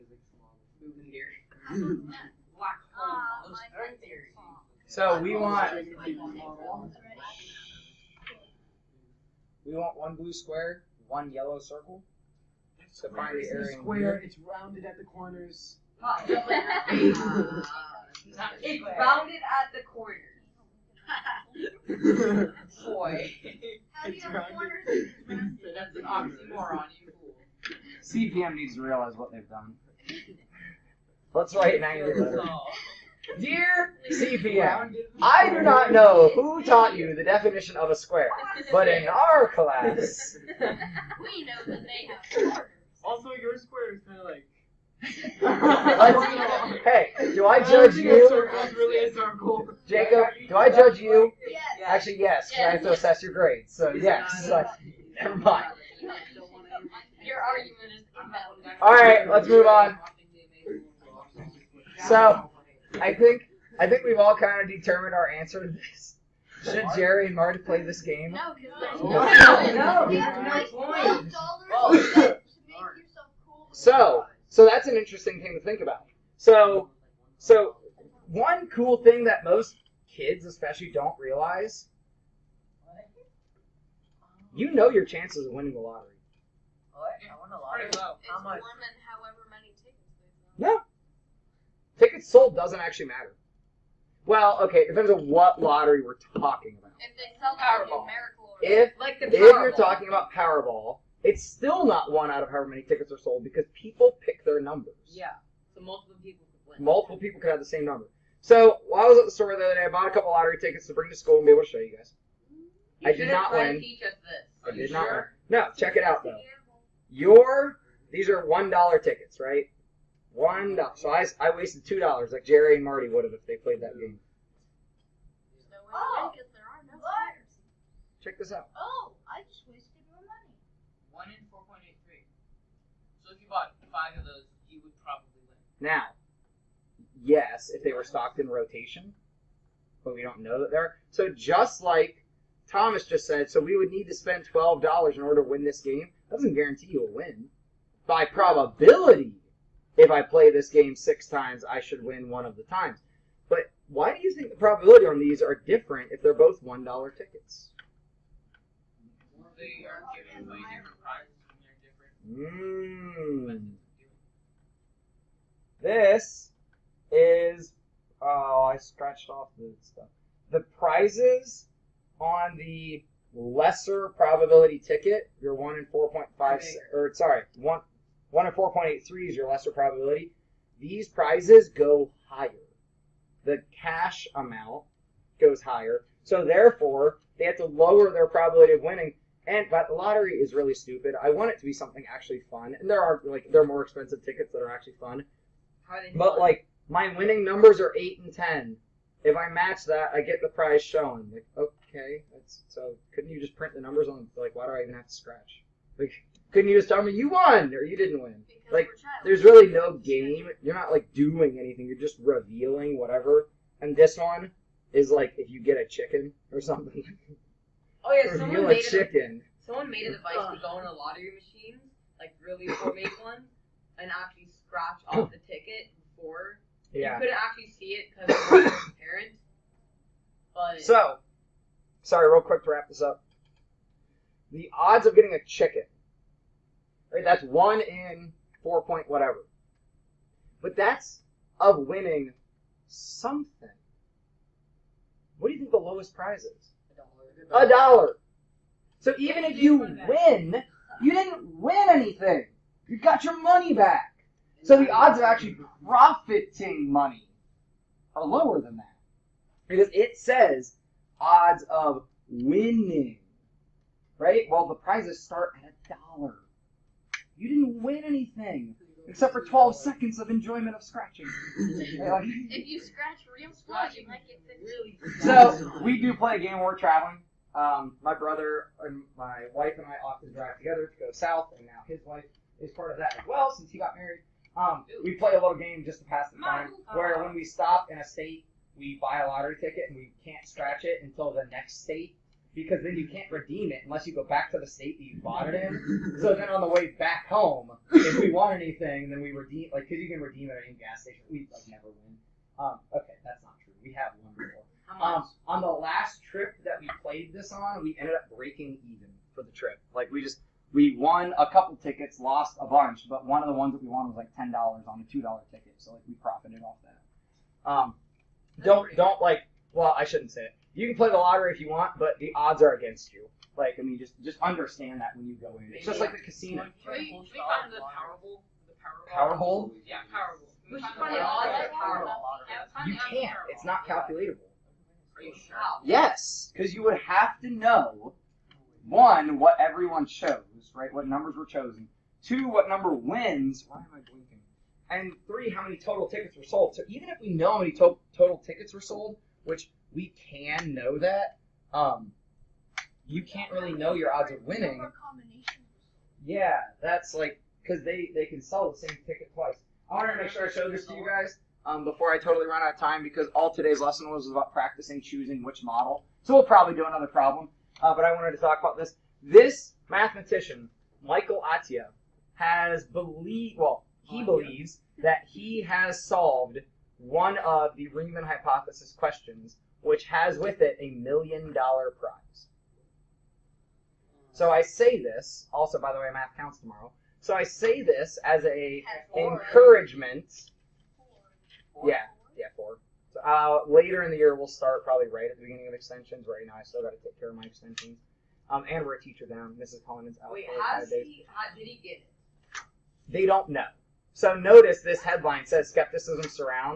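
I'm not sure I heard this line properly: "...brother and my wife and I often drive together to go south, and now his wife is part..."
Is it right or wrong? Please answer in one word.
right.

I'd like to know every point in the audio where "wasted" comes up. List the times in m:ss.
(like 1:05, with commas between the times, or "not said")
2:01, 2:09.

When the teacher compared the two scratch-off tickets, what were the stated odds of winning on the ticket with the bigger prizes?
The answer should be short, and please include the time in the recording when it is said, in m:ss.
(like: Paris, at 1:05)
1 in 4.83, at 2:11.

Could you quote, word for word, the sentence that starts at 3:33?
And this one is like if you get a chicken or something.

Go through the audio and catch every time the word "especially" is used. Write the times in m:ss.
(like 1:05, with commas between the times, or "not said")
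1:20.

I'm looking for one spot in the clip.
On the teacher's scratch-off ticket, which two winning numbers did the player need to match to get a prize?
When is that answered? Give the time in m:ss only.
3:17.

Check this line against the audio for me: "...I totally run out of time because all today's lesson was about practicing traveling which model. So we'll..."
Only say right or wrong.
wrong.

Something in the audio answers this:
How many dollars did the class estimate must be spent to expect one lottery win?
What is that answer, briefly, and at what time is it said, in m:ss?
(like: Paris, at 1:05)
12, at 2:24.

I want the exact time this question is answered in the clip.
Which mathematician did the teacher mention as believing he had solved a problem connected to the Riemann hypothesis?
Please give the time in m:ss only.
6:11.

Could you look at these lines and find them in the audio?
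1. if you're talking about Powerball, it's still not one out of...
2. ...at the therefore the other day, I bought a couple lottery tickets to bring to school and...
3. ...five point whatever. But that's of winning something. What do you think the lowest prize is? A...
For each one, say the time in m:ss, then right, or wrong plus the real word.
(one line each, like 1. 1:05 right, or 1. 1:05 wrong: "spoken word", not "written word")
1. 1:39 right
2. 1:49 wrong: "store", not "therefore"
3. 3:58 wrong: "four", not "five".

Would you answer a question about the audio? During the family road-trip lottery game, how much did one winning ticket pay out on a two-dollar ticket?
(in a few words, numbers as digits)
$10.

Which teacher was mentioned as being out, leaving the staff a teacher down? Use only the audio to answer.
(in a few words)
Mrs. Collins.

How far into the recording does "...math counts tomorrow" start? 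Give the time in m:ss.
6:26.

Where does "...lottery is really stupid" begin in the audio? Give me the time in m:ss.
3:09.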